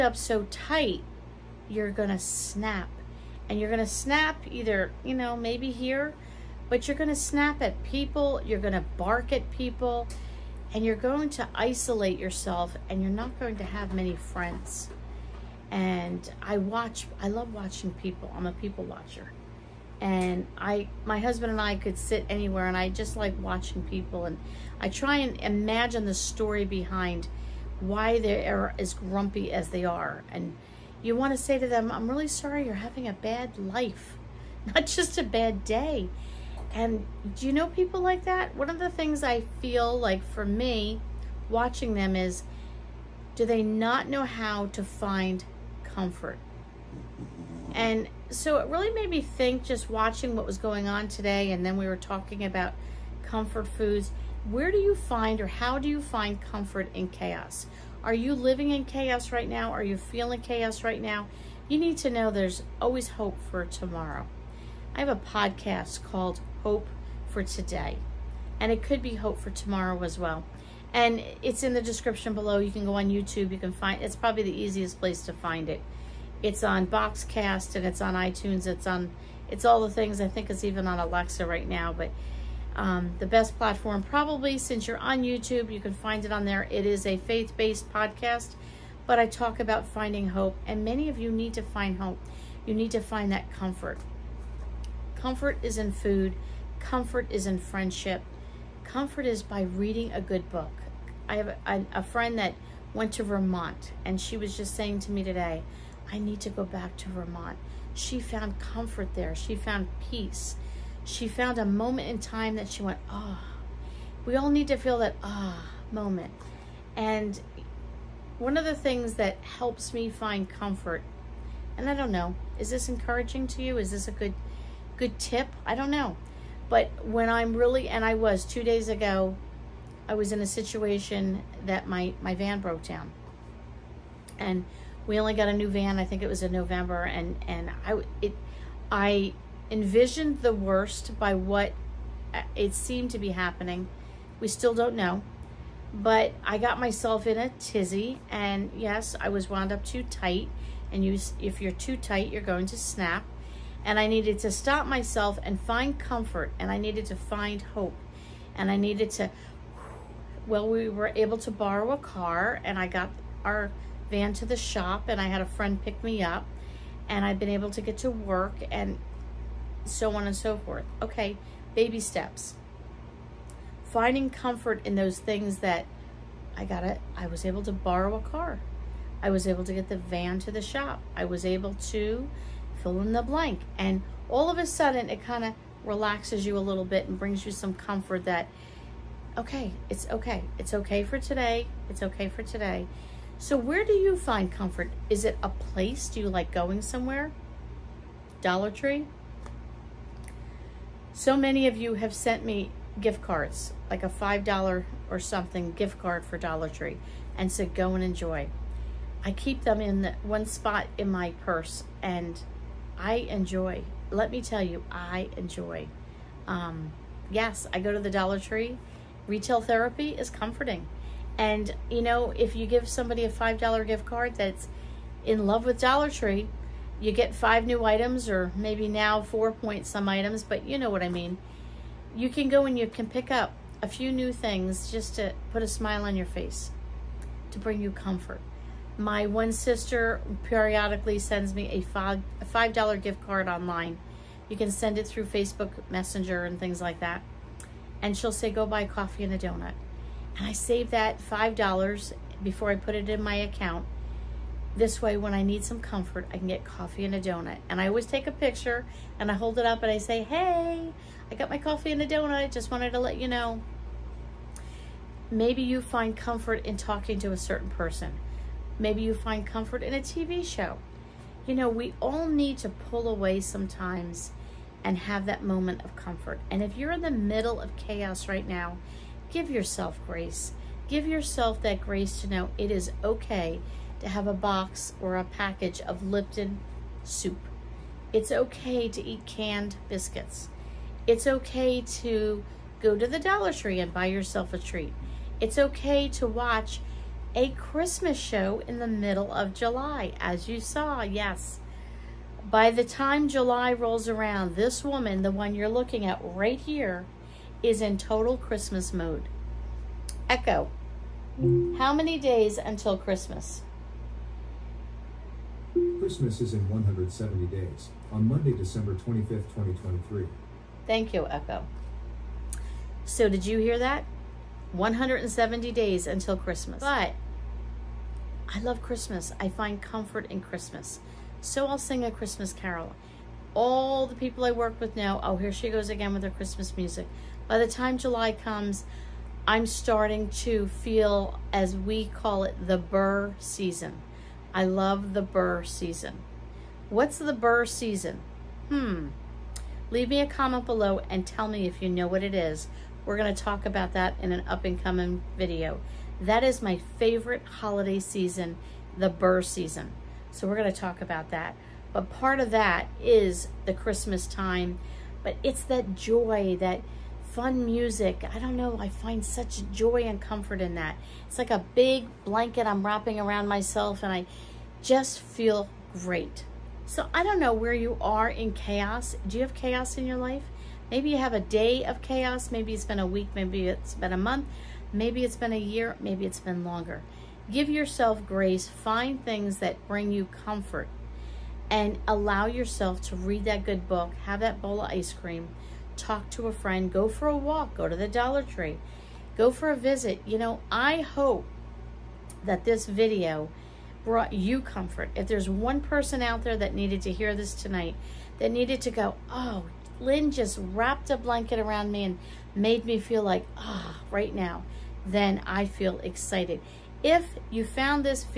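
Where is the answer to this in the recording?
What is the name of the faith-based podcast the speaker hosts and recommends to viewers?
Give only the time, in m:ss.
1:06.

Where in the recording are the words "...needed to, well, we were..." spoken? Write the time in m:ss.
2:38.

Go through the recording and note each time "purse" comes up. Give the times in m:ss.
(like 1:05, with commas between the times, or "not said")
3:31.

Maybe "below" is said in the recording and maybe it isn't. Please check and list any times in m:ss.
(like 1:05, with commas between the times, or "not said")
1:12, 5:50.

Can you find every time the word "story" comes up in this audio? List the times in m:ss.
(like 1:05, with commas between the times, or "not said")
0:26.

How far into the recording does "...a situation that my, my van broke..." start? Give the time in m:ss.
2:10.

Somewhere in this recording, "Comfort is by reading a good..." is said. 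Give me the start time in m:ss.
1:38.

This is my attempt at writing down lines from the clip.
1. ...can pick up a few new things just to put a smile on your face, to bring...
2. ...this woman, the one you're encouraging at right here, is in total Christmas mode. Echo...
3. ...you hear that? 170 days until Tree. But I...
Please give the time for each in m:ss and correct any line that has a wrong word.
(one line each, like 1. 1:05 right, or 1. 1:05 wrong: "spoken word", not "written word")
1. 3:52 right
2. 5:04 wrong: "looking", not "encouraging"
3. 5:23 wrong: "Christmas", not "Tree".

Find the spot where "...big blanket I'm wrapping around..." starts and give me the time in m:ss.
6:11.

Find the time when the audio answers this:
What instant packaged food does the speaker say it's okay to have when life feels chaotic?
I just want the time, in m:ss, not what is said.
4:46.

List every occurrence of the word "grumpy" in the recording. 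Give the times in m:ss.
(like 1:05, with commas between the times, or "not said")
0:28.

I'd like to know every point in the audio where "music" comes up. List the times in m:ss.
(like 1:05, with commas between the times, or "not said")
5:36, 6:07.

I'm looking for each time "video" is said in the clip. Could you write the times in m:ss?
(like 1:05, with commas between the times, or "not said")
5:55, 6:42.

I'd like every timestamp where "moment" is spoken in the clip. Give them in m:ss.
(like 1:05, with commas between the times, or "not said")
1:51, 1:55, 4:35.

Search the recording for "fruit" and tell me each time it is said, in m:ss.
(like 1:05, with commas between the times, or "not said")
not said.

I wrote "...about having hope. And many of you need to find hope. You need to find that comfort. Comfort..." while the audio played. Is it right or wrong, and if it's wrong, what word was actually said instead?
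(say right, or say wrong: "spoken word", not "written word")
wrong: "finding", not "having".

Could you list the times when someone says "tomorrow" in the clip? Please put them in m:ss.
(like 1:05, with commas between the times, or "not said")
1:03, 1:09.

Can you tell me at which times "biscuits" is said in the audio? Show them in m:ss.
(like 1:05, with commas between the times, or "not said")
4:49.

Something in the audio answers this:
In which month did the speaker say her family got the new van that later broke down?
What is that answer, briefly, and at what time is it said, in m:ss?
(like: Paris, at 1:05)
November, at 2:16.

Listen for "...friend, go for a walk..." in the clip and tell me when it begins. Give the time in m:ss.
6:36.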